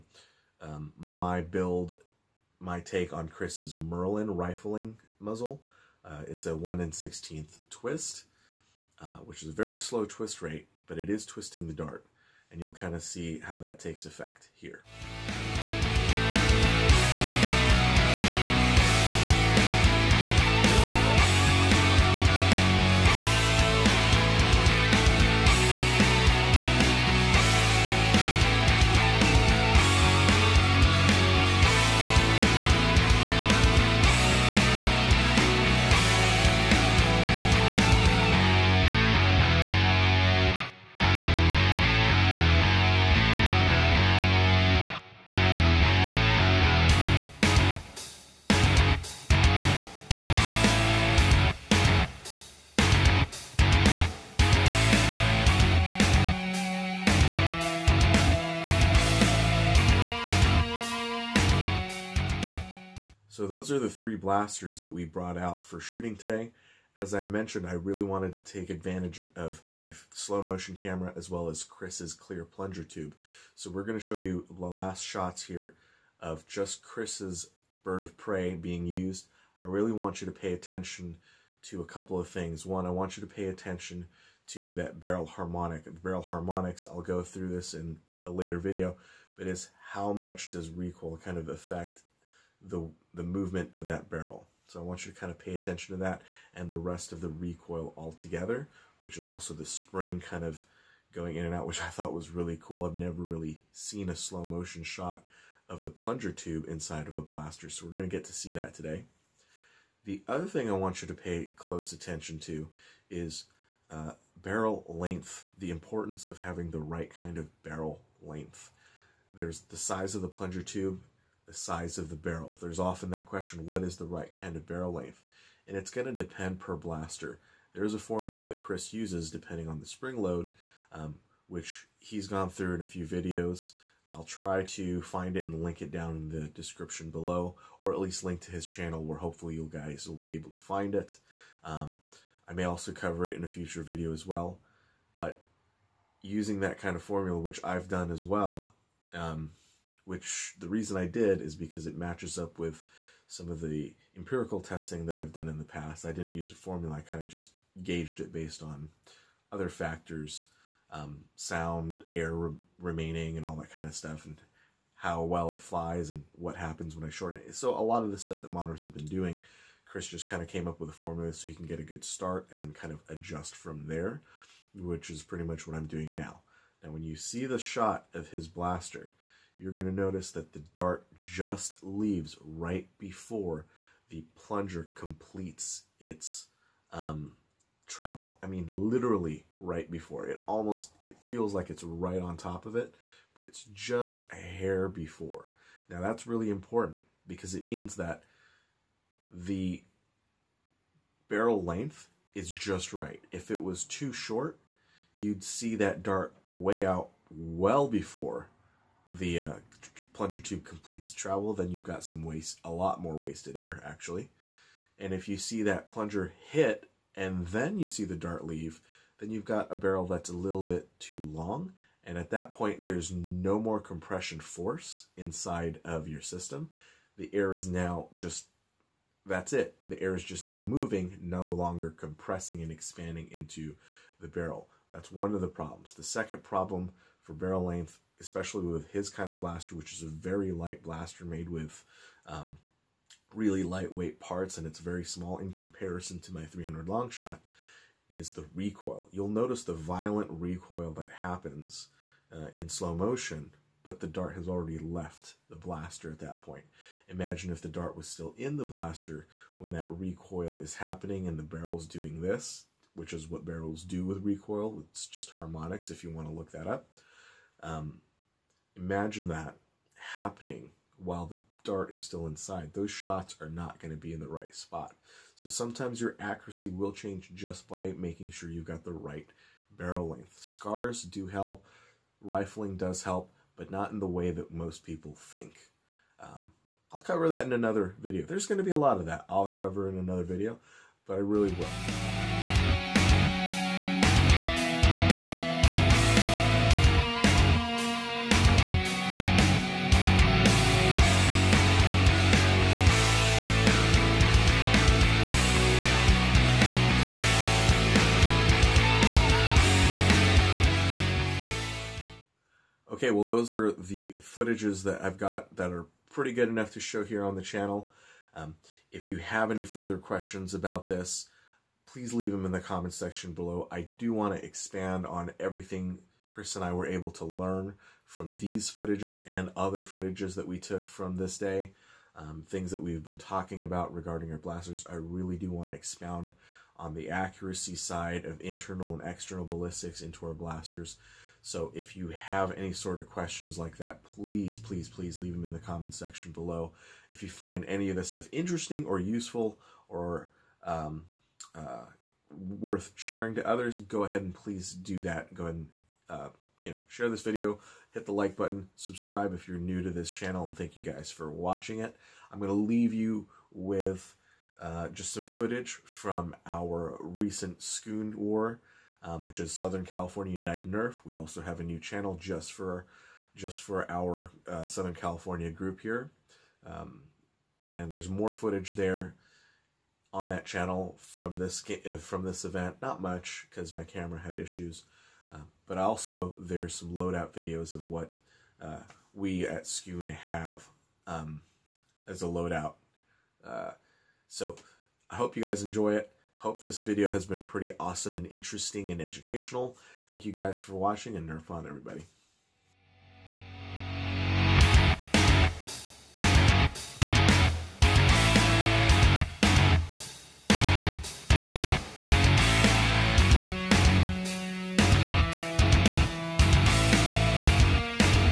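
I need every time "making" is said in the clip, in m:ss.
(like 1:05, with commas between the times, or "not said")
4:37.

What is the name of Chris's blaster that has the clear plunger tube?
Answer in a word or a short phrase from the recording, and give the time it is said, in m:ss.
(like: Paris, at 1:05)
Bird of prey, at 1:17.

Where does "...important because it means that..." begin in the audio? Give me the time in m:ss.
3:16.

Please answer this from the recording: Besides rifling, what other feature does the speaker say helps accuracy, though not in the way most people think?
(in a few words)
Scars.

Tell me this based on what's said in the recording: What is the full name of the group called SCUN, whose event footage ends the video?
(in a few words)
Southern California United Nerf.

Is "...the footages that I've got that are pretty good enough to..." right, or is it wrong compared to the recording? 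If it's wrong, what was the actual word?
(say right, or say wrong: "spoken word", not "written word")
right.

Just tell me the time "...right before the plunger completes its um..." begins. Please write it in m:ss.
3:02.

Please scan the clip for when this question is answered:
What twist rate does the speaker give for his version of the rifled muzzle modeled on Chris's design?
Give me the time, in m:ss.
0:06.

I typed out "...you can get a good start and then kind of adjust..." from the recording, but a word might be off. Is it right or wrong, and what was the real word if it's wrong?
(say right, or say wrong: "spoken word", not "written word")
right.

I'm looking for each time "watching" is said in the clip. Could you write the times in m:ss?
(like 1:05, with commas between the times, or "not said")
6:01, 6:40.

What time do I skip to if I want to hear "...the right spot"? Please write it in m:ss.
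4:34.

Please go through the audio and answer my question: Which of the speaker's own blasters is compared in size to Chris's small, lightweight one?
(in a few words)
300 long shot.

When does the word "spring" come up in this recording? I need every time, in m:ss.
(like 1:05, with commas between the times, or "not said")
1:39, 2:09.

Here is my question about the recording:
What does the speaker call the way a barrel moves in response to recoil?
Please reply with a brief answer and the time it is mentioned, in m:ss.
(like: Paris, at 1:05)
Barrel harmonics, at 1:24.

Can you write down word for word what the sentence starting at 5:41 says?
So if you have any sort of questions like that, please, please, please leave them in the comments section below.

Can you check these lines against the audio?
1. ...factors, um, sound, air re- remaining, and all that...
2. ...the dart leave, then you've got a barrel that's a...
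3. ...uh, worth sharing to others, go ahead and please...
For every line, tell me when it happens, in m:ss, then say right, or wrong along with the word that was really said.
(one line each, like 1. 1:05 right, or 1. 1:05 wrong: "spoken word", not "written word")
1. 2:39 right
2. 3:38 right
3. 5:51 right.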